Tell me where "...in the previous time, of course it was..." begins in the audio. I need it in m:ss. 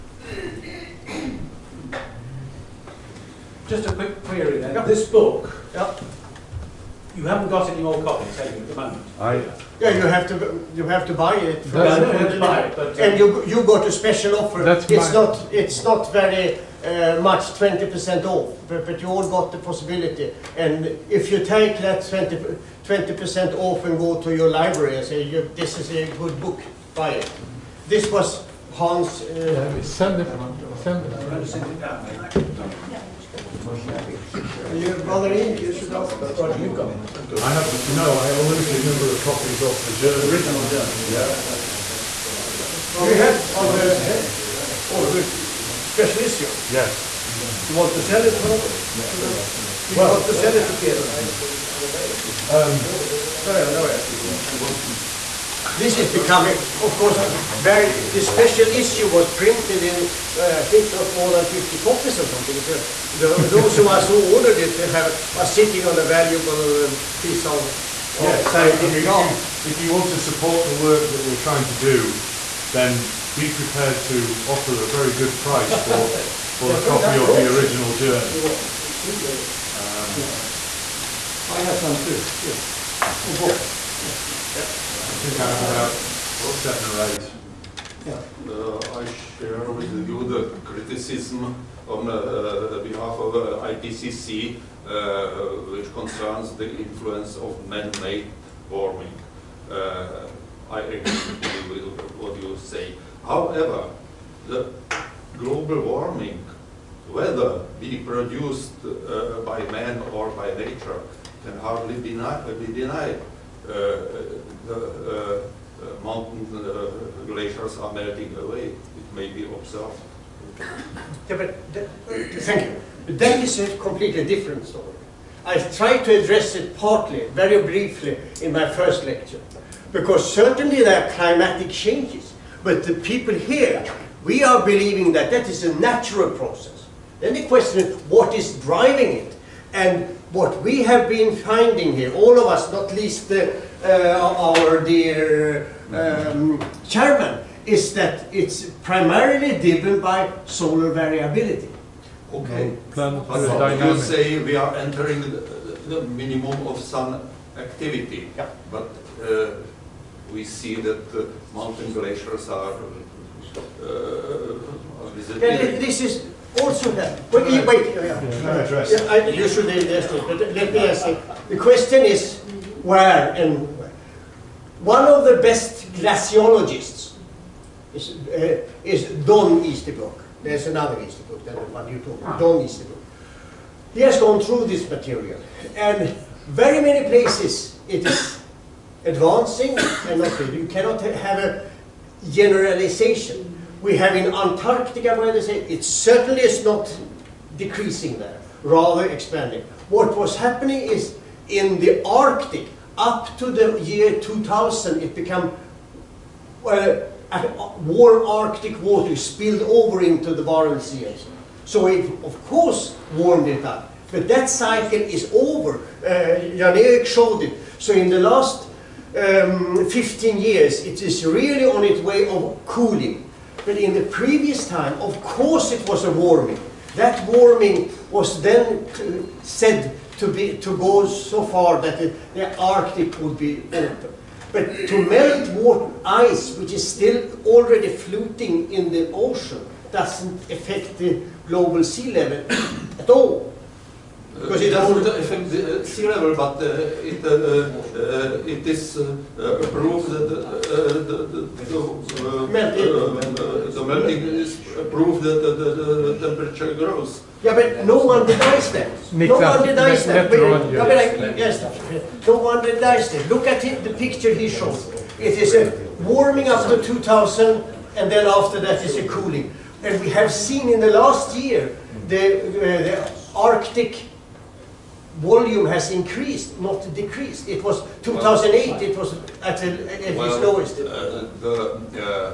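3:43.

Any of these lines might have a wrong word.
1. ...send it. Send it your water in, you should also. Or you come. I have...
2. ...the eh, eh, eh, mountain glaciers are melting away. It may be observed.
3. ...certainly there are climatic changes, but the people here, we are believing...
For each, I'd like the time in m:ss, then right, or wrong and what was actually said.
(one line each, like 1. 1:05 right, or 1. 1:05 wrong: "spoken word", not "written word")
1. 0:29 wrong: "brother", not "water"
2. 1:53 right
3. 2:10 right.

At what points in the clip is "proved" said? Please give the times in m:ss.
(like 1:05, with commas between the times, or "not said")
4:09, 4:14.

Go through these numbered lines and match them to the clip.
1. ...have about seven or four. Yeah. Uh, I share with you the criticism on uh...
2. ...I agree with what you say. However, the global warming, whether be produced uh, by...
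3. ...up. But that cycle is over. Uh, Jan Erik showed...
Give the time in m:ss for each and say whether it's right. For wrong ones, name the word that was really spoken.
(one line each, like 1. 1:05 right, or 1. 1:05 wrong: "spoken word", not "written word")
1. 1:25 wrong: "eight", not "four"
2. 1:40 right
3. 3:33 right.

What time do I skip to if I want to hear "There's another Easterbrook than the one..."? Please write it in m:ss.
3:00.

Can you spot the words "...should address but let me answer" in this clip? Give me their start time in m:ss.
2:49.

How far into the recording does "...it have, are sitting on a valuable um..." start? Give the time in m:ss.
1:04.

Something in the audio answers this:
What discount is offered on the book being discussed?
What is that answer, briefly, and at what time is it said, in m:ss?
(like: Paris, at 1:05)
20 percent, at 0:17.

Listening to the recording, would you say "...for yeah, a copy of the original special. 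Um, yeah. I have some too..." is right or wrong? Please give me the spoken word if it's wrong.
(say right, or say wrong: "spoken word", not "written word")
wrong: "journal", not "special".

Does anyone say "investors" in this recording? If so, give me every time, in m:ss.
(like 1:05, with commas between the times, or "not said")
not said.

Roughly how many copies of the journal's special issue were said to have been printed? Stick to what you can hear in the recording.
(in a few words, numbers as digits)
50.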